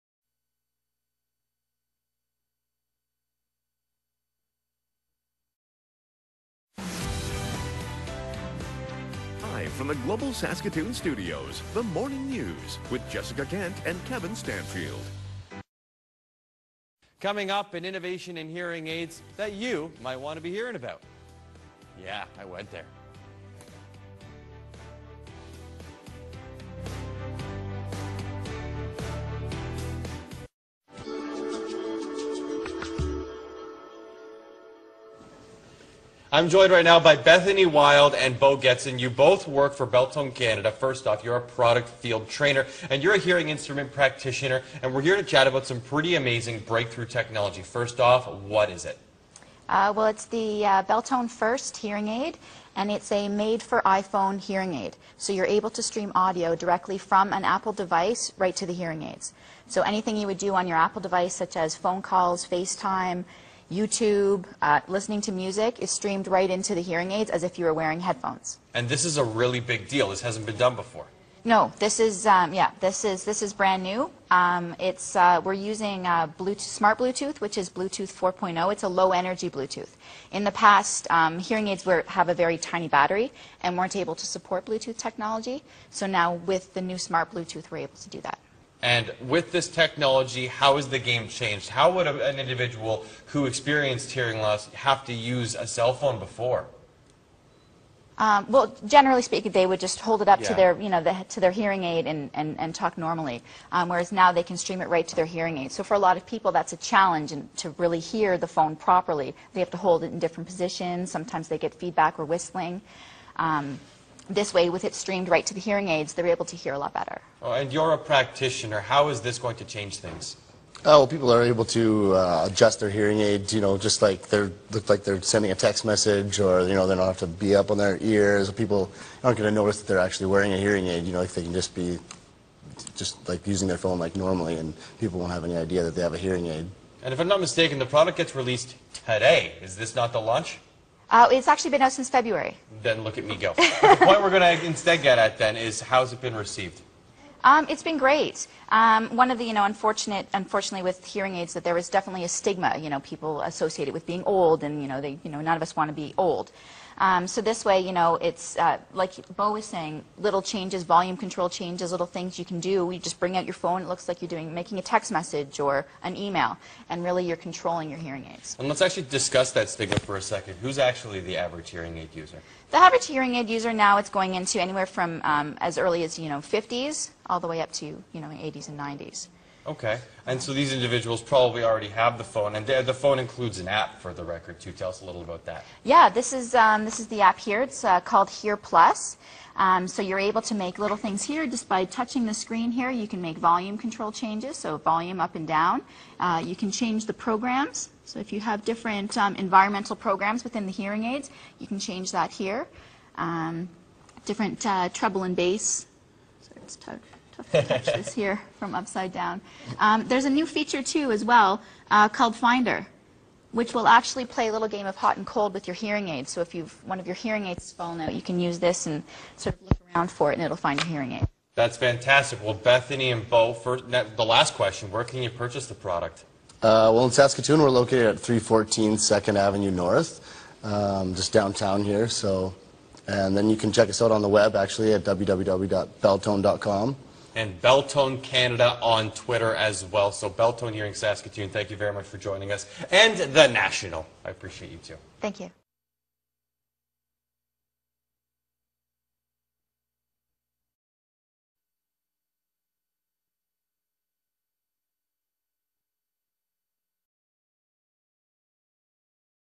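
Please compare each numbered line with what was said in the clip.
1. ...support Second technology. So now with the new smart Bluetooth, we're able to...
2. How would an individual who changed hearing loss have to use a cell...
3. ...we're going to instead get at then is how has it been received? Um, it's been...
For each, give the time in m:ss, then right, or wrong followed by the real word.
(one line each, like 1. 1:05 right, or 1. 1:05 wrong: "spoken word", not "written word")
1. 1:24 wrong: "Bluetooth", not "Second"
2. 1:31 wrong: "experienced", not "changed"
3. 2:24 right.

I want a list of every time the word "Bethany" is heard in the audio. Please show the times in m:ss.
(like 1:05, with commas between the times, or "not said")
0:37, 3:42.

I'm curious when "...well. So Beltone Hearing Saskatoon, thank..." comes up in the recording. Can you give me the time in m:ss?
3:59.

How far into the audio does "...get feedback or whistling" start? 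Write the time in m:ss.
1:51.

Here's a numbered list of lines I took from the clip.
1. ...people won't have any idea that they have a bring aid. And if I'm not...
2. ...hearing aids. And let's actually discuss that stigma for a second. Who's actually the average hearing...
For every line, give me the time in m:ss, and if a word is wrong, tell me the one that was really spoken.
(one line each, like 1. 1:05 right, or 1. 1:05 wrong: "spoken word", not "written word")
1. 2:14 wrong: "hearing", not "bring"
2. 2:47 right.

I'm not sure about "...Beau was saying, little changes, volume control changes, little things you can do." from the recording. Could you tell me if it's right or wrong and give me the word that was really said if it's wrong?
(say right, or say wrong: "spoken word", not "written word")
right.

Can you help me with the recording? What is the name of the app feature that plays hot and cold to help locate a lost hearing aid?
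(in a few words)
Finder.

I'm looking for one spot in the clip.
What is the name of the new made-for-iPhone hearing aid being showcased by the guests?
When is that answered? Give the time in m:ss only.
0:50.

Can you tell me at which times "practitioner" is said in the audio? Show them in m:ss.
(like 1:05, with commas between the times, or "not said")
0:43, 1:57.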